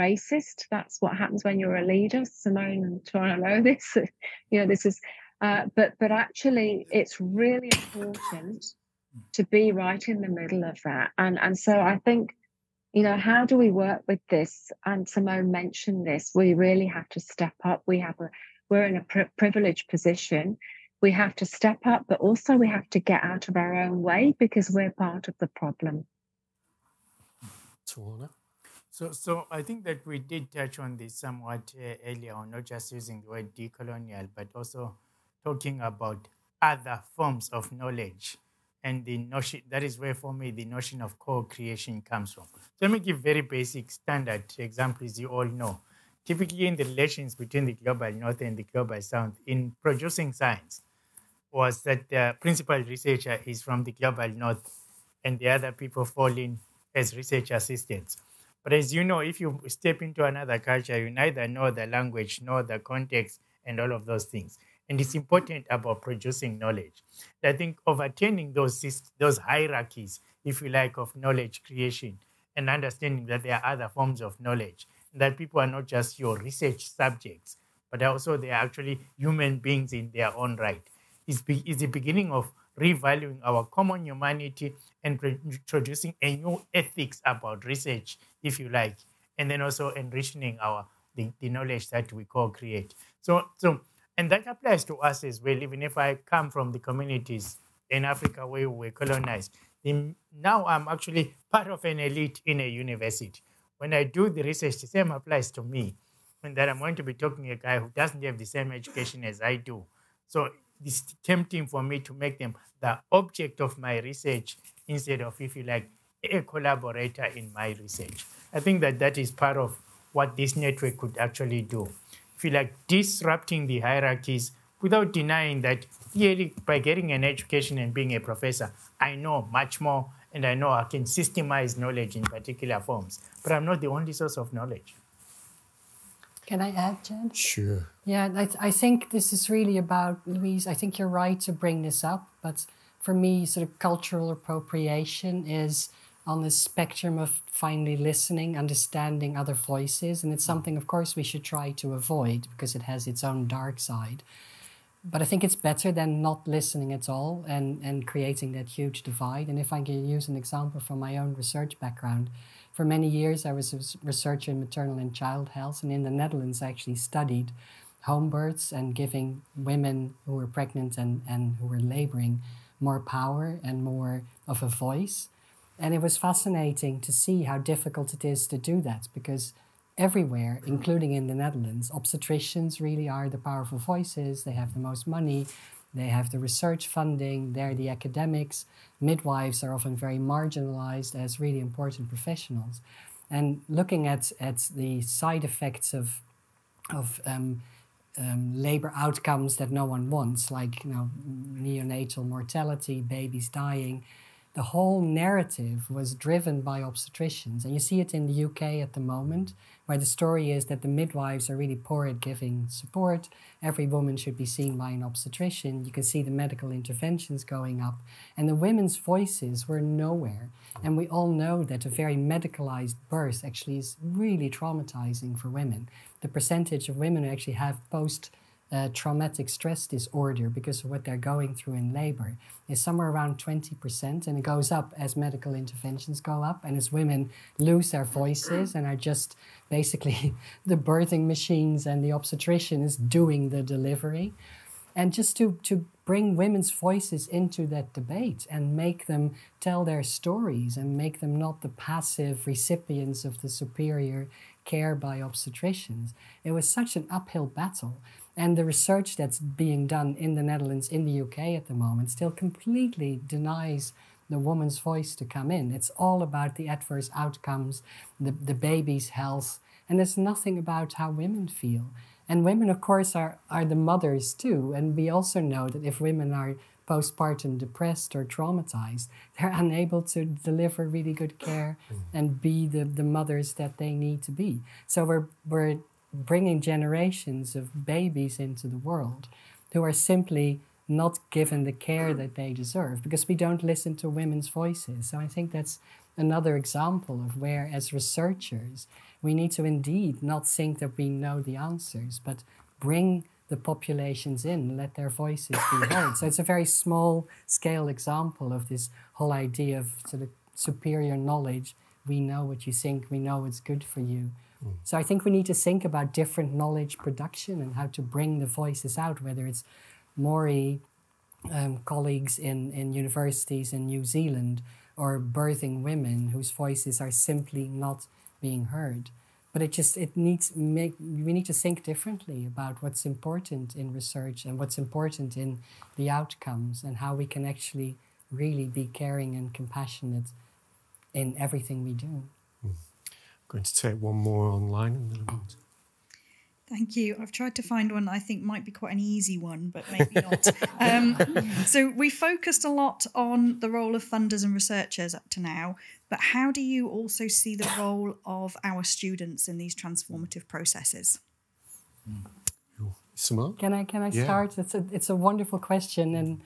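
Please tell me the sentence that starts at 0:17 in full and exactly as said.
We have a we're in a privileged position.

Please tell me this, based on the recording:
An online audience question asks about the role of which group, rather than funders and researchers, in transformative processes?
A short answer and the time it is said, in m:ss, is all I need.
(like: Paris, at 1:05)
students, at 5:58.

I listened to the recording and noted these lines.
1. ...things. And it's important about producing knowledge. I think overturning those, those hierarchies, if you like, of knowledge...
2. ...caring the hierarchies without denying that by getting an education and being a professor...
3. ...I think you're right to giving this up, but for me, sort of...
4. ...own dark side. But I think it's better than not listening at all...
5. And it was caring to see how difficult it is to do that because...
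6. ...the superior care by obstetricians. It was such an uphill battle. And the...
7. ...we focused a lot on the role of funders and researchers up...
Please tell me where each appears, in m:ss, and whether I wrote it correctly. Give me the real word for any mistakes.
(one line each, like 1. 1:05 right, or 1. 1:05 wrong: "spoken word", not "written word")
1. 1:04 right
2. 2:02 wrong: "disrupting", not "caring"
3. 2:20 wrong: "bring", not "giving"
4. 2:33 right
5. 2:55 wrong: "fascinating", not "caring"
6. 4:13 right
7. 5:51 right.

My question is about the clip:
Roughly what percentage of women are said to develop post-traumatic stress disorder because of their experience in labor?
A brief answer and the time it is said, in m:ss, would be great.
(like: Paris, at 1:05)
20%, at 3:53.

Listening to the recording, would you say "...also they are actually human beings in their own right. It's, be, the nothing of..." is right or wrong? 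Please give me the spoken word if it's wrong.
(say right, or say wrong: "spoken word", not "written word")
wrong: "beginning", not "nothing".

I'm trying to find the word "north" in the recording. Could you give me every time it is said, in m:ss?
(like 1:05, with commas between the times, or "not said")
0:48, 0:54.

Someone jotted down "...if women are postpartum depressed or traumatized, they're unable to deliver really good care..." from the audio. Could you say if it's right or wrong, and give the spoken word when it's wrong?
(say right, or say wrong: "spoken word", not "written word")
right.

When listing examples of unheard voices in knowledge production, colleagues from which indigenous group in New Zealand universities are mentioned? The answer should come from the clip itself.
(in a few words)
Maori.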